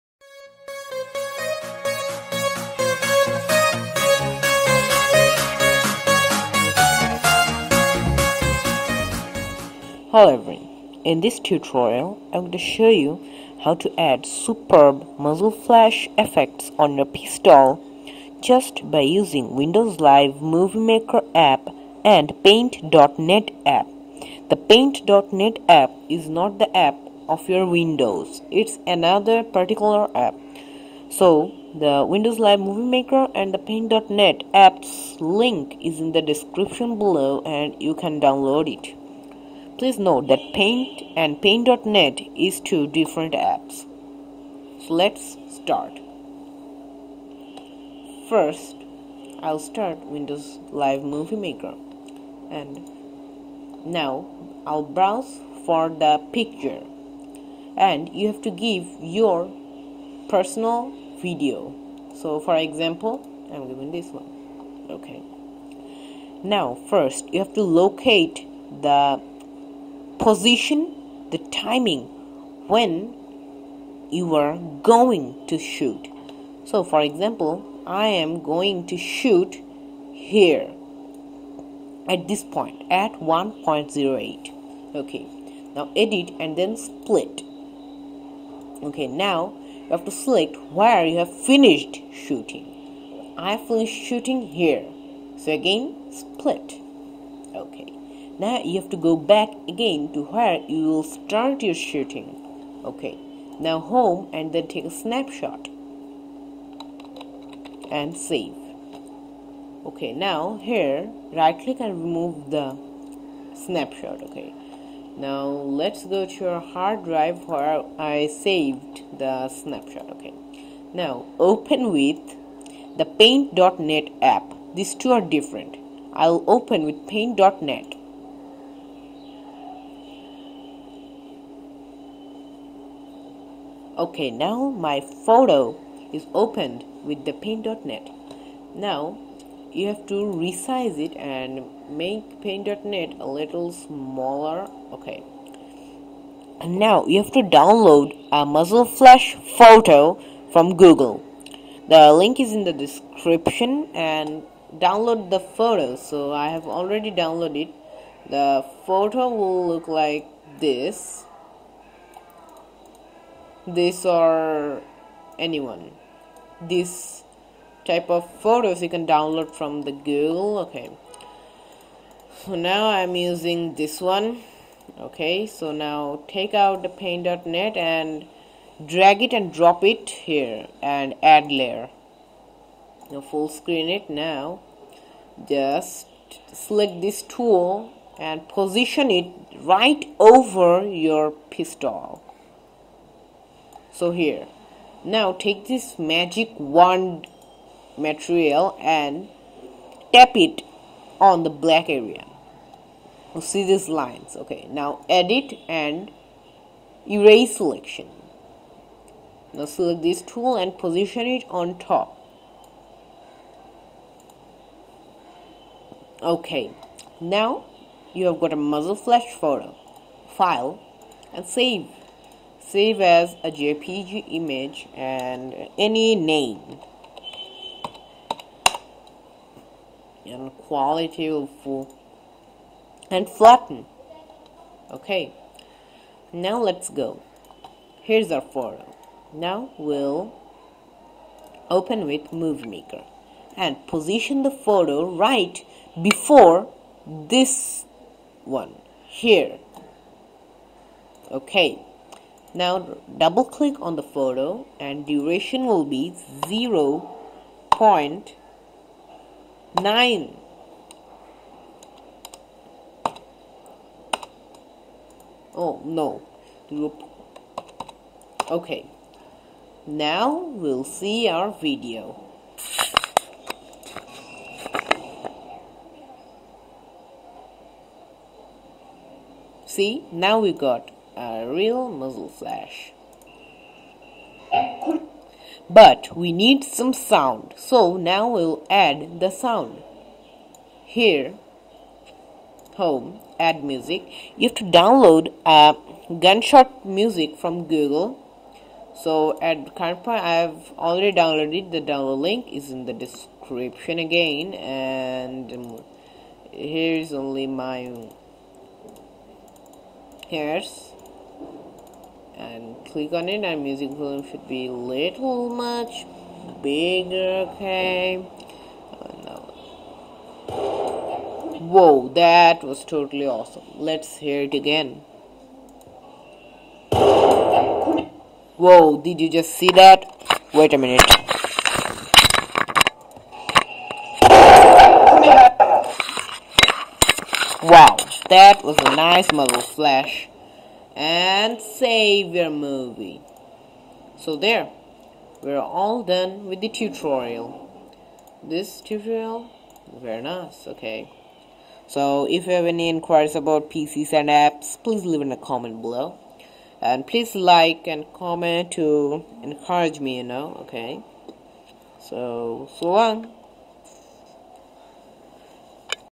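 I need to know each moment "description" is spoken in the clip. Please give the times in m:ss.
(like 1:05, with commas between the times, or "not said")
0:36, 2:32, 5:02.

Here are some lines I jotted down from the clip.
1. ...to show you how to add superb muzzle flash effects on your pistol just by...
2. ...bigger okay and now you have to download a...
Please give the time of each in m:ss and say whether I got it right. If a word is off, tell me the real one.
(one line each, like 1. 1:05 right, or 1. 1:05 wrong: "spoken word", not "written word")
1. 0:12 right
2. 2:23 wrong: "smaller", not "bigger".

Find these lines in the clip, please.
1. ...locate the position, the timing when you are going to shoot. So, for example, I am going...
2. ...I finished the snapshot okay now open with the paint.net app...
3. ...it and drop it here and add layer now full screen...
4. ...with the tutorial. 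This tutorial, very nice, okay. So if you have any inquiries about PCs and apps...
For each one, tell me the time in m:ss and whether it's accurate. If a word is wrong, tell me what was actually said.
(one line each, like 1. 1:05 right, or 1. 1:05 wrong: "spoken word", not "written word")
1. 1:07 right
2. 1:58 wrong: "saved", not "finished"
3. 2:59 right
4. 5:46 right.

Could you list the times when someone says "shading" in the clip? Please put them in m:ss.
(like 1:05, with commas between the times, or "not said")
not said.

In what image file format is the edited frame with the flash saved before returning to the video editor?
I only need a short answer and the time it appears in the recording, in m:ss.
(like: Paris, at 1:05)
JPG, at 3:43.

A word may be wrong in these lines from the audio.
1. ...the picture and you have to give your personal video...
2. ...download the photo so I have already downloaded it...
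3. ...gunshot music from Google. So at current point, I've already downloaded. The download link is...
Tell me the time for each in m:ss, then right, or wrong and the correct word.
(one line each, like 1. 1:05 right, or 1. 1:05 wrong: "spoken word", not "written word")
1. 0:55 right
2. 2:34 right
3. 4:56 right.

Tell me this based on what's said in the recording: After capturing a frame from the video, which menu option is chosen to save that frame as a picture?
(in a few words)
take a snapshot.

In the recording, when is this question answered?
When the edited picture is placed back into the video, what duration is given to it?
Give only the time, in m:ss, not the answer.
4:16.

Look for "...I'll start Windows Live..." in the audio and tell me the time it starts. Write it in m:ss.
0:49.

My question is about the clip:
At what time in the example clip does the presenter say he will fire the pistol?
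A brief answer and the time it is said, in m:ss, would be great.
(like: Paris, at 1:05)
1.08, at 1:23.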